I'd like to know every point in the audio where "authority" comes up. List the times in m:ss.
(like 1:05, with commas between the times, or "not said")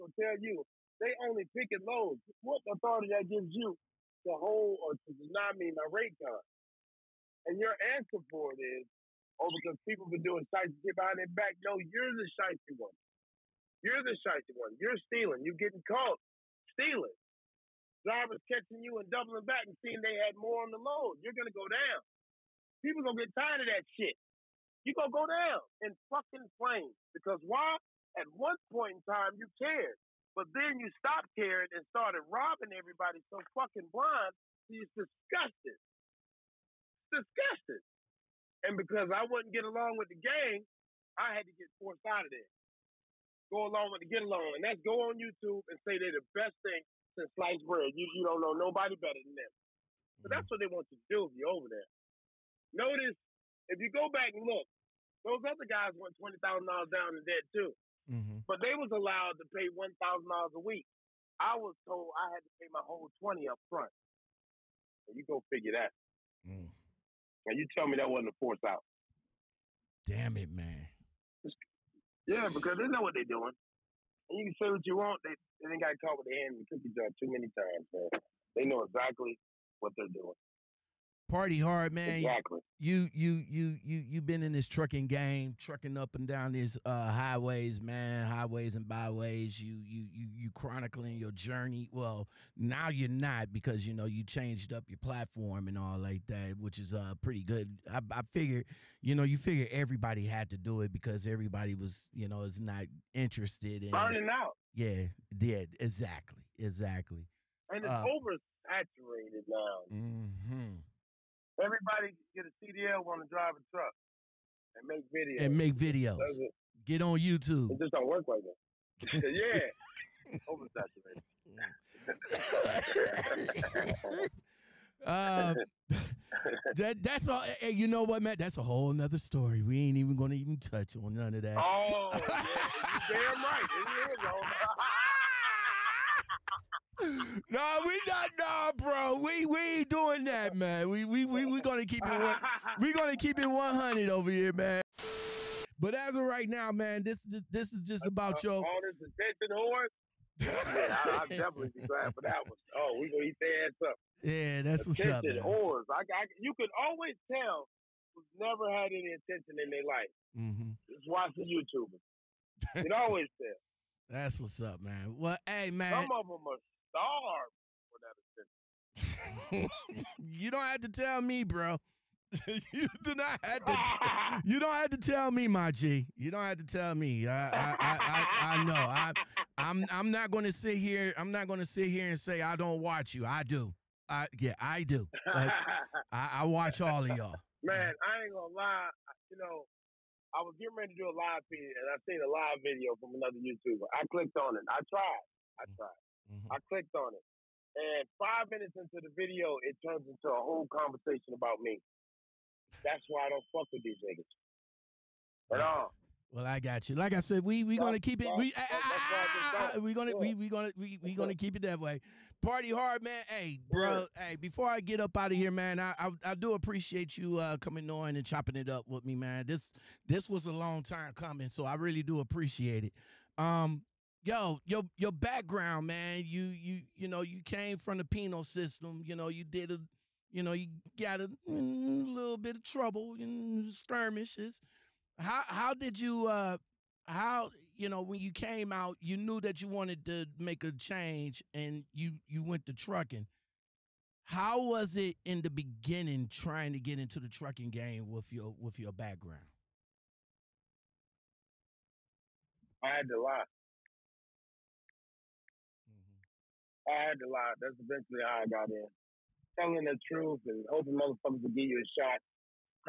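0:02.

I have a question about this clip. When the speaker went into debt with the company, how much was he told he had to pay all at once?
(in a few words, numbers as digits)
$20,000.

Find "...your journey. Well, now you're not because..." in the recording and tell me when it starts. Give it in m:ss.
1:31.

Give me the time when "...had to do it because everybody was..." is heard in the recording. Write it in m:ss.
1:40.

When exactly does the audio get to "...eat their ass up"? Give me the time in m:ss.
2:33.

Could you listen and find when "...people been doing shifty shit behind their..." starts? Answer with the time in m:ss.
0:09.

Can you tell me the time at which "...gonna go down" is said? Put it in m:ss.
0:21.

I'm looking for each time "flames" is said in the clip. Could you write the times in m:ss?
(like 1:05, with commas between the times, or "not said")
0:26.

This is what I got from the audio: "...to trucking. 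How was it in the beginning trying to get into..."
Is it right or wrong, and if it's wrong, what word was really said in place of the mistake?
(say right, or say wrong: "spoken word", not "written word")
right.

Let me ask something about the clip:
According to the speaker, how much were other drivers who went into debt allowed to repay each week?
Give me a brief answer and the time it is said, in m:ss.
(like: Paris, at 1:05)
$1,000, at 0:59.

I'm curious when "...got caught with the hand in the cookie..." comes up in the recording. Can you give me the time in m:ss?
1:15.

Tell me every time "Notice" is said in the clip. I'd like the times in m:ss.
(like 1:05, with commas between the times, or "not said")
0:52.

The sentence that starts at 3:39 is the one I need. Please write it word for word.
This this was a long time coming, so I really do appreciate it.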